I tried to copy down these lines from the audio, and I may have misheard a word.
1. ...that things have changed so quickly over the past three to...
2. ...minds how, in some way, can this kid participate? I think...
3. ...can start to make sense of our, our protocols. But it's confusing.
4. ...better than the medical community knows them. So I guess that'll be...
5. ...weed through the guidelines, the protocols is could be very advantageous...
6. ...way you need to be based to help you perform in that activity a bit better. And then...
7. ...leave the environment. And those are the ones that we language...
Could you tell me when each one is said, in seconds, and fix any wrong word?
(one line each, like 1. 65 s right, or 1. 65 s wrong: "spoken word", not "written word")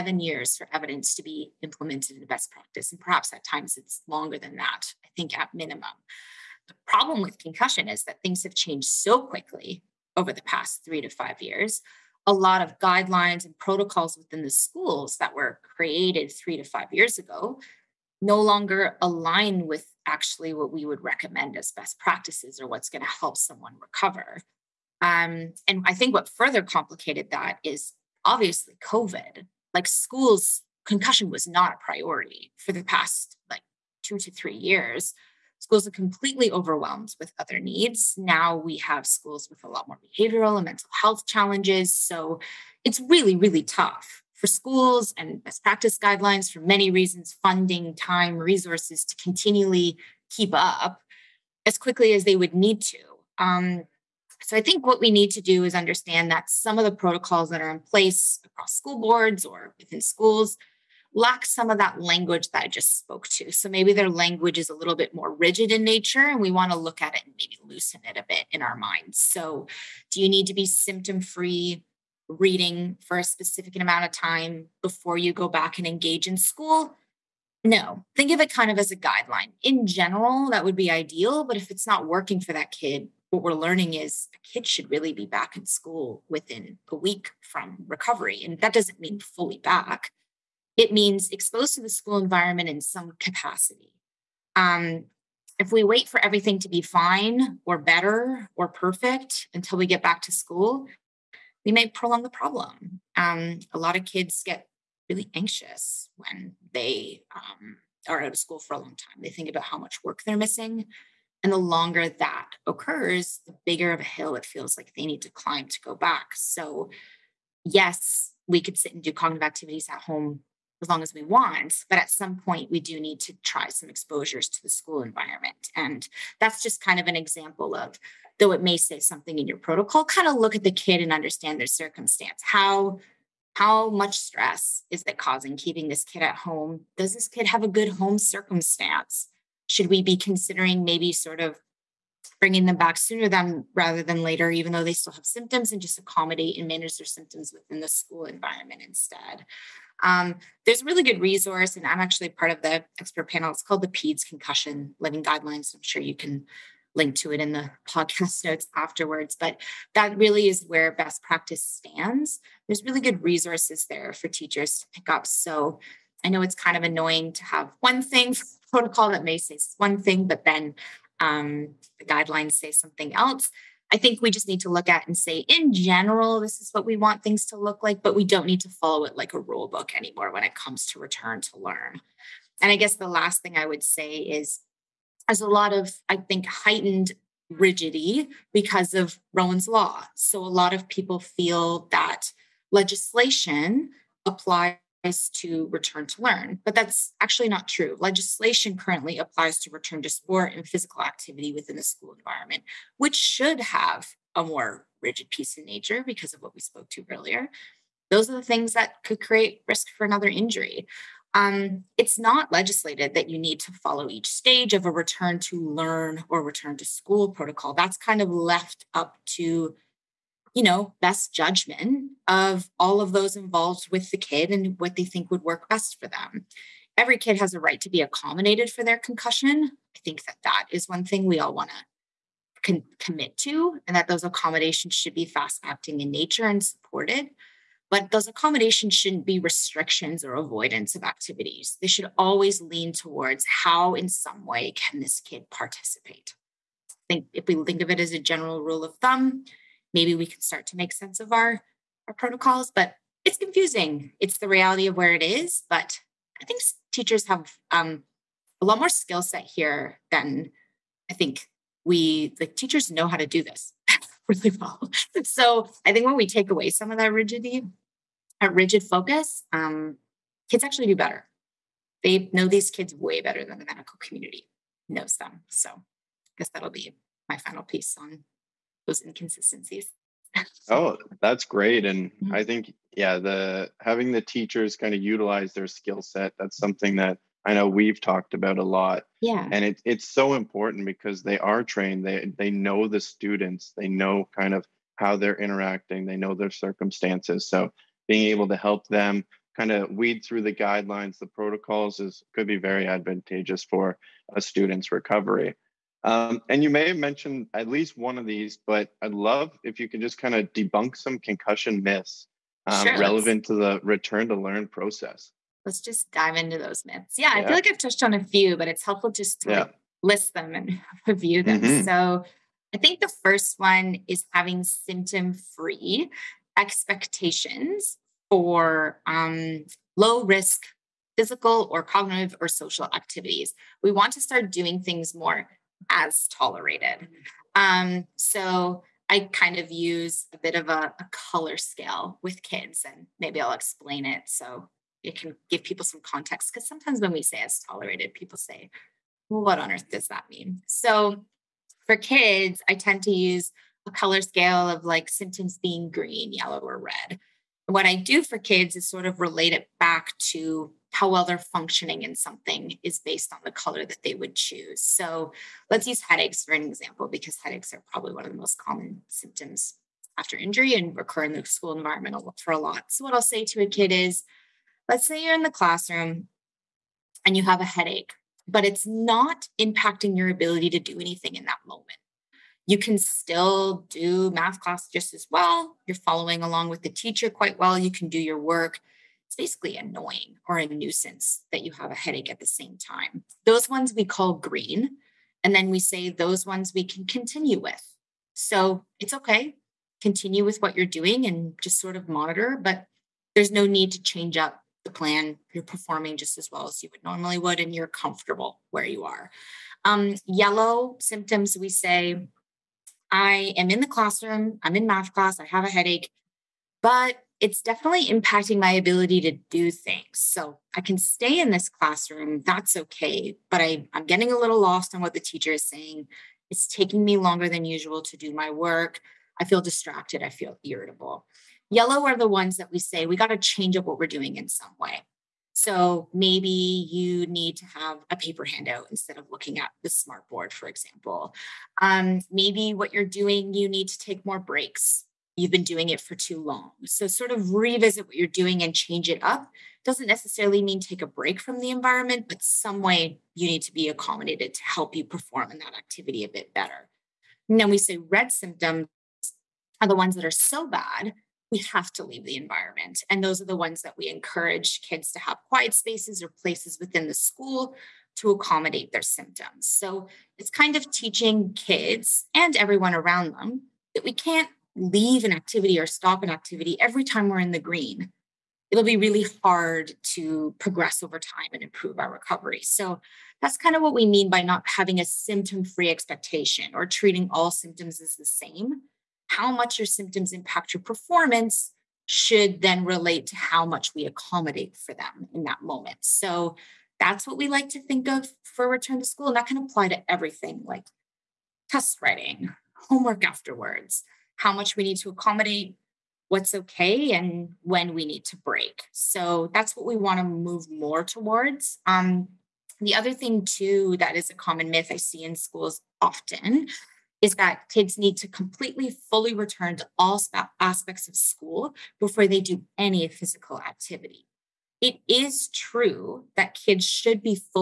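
1. 8 s right
2. 242 s wrong: "towards", not "minds"
3. 250 s right
4. 273 s right
5. 299 s right
6. 452 s wrong: "accommodated", not "based"
7. 462 s wrong: "encourage", not "language".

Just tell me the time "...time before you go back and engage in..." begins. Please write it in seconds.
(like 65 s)
74 s.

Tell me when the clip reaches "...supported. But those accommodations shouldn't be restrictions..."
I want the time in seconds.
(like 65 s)
236 s.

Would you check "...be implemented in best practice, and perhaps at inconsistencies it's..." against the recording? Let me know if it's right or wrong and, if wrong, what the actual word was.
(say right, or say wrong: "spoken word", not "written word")
wrong: "times", not "inconsistencies".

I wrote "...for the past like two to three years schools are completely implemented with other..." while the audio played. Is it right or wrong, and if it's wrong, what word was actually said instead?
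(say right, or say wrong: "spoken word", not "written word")
wrong: "overwhelmed", not "implemented".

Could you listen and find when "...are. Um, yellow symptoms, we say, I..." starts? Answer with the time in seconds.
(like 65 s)
409 s.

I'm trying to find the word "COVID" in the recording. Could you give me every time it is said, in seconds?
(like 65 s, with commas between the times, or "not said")
28 s.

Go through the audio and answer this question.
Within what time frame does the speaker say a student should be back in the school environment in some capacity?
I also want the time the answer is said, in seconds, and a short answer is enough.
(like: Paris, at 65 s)
within a week, at 86 s.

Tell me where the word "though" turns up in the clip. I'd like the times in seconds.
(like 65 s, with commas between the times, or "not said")
128 s, 144 s.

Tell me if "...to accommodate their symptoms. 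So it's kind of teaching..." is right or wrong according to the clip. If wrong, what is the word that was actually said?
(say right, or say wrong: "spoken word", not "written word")
right.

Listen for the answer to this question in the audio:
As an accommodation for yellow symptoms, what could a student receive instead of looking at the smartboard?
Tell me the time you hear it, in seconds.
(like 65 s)
438 s.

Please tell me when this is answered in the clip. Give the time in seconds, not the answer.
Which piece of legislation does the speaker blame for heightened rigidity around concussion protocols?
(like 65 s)
189 s.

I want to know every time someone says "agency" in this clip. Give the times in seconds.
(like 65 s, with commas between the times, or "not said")
not said.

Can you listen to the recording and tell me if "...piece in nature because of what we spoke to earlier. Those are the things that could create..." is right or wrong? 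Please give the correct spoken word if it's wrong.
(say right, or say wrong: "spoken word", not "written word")
right.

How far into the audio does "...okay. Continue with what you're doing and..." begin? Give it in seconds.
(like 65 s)
399 s.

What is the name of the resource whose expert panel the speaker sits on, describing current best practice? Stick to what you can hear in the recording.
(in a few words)
PEDS Concussion Living Guidelines.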